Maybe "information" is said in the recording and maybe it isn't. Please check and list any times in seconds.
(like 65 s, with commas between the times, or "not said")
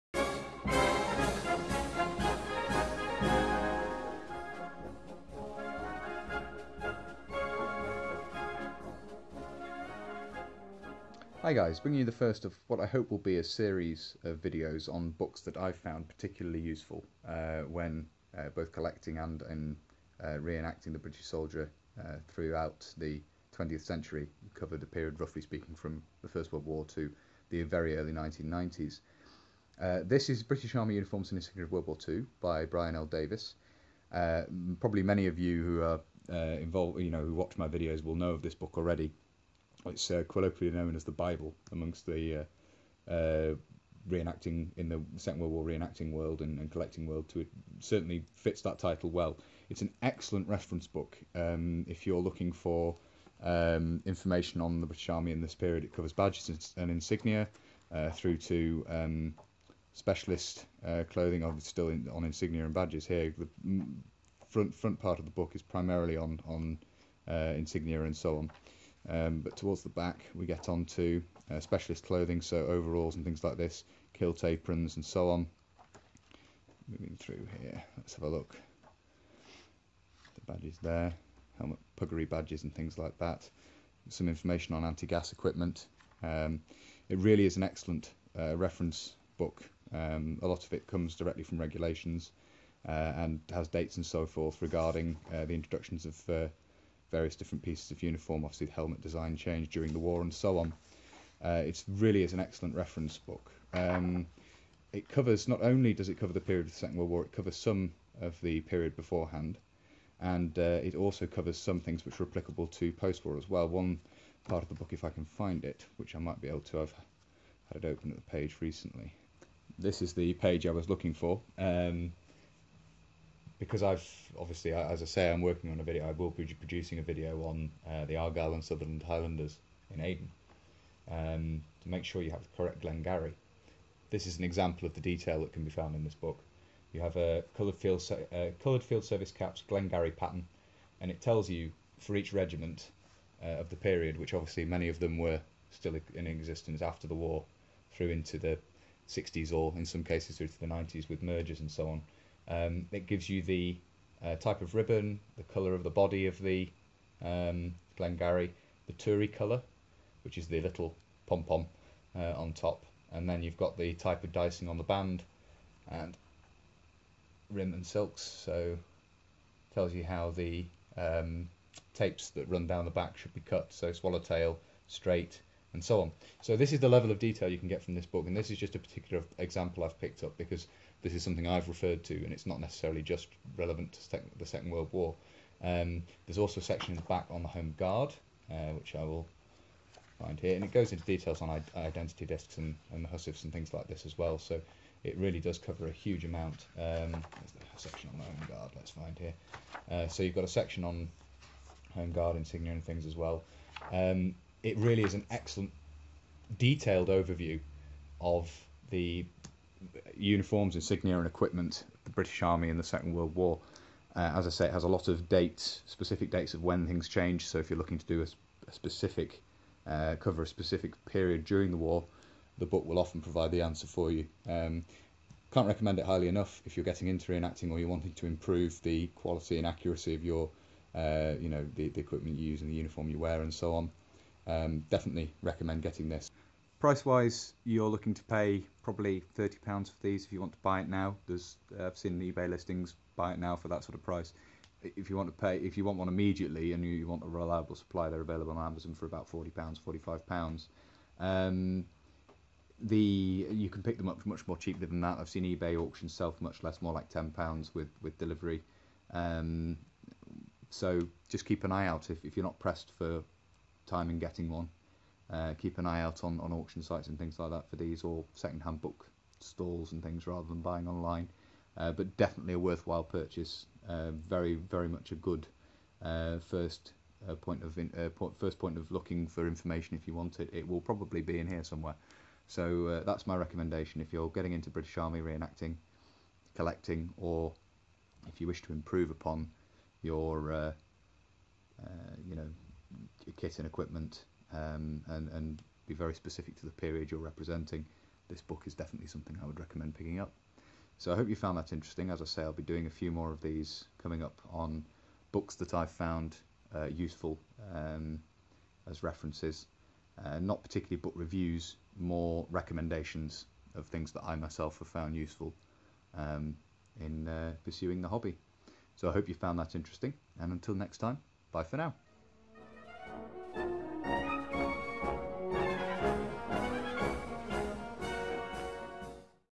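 54 s, 84 s, 279 s.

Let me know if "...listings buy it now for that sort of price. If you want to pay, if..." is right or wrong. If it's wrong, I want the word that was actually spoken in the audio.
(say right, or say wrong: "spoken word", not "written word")
right.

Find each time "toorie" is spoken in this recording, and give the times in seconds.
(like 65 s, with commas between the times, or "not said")
158 s.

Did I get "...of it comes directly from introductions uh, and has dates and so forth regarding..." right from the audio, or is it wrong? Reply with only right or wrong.
wrong.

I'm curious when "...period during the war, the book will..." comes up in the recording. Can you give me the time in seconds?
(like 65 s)
221 s.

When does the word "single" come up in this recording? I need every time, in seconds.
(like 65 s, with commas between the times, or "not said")
not said.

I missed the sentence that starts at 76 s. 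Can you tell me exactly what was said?
Moving through here, let's have a look.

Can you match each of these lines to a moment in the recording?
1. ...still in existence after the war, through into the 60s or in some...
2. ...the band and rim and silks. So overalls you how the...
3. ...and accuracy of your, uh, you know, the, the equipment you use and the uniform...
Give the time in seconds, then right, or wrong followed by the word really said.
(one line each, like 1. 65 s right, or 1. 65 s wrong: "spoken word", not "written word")
1. 145 s right
2. 164 s wrong: "tells", not "overalls"
3. 229 s right.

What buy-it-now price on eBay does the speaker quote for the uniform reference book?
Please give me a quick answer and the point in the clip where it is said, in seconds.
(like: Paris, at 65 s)
£30, at 239 s.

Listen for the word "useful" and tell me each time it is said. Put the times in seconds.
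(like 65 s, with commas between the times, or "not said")
16 s, 306 s, 315 s.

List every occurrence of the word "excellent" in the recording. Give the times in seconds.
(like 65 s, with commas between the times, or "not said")
50 s, 87 s, 102 s, 205 s.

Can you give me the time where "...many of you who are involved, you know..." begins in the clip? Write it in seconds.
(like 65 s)
35 s.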